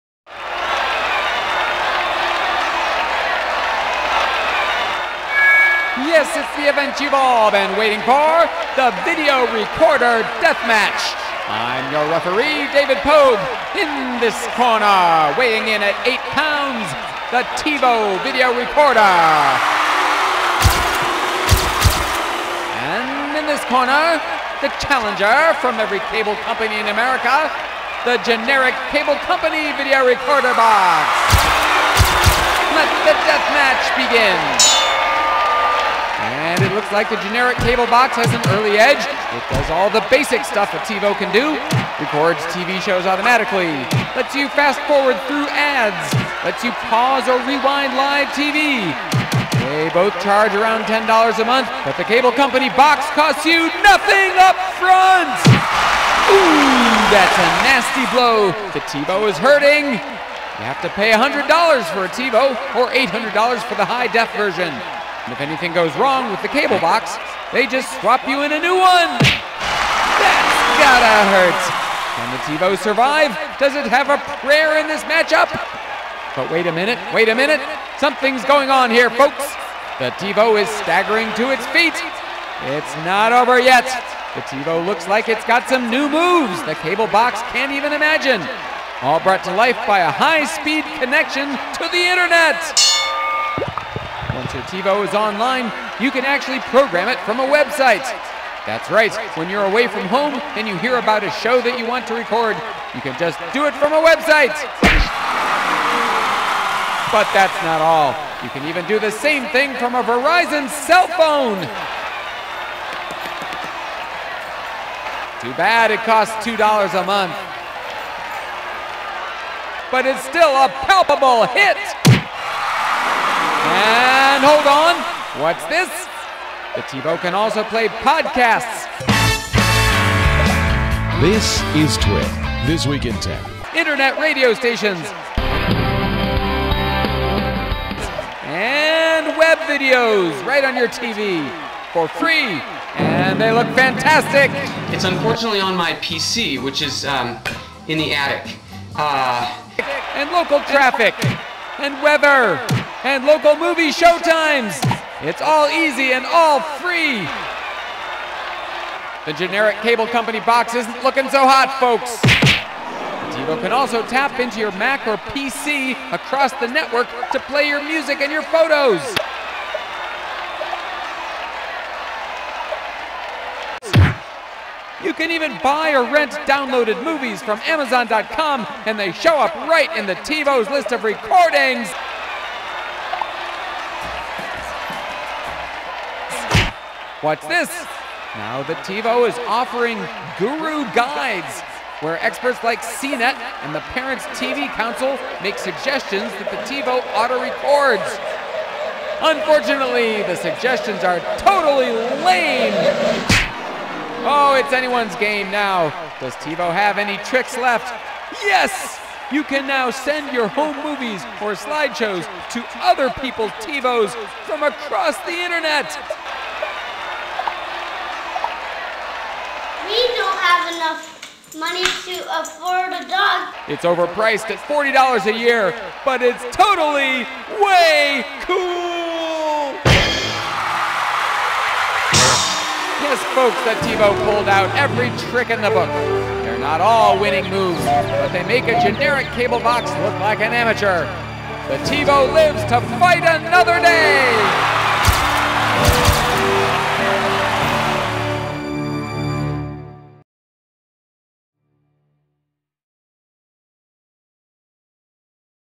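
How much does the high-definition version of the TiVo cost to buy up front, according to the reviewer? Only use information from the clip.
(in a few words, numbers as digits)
$800.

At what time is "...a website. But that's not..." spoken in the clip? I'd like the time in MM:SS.
01:43.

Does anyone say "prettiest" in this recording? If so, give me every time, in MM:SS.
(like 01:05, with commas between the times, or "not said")
not said.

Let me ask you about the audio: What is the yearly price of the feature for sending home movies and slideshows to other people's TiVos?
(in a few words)
$40 a year.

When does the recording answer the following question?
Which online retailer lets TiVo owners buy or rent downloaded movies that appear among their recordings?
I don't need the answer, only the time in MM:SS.
02:57.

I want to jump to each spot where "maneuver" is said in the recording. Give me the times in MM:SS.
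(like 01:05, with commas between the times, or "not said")
not said.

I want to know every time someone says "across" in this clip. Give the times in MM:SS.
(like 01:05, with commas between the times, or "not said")
02:46, 03:34.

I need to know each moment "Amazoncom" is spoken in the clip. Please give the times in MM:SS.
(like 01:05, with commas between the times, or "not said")
02:57.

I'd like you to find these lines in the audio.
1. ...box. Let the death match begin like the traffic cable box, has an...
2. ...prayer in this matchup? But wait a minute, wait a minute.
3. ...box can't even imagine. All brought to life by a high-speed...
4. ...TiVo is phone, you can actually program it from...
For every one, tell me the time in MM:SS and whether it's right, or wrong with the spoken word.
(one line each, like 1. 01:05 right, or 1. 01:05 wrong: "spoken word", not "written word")
1. 00:30 wrong: "generic", not "traffic"
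2. 01:14 right
3. 01:27 right
4. 01:34 wrong: "online", not "phone".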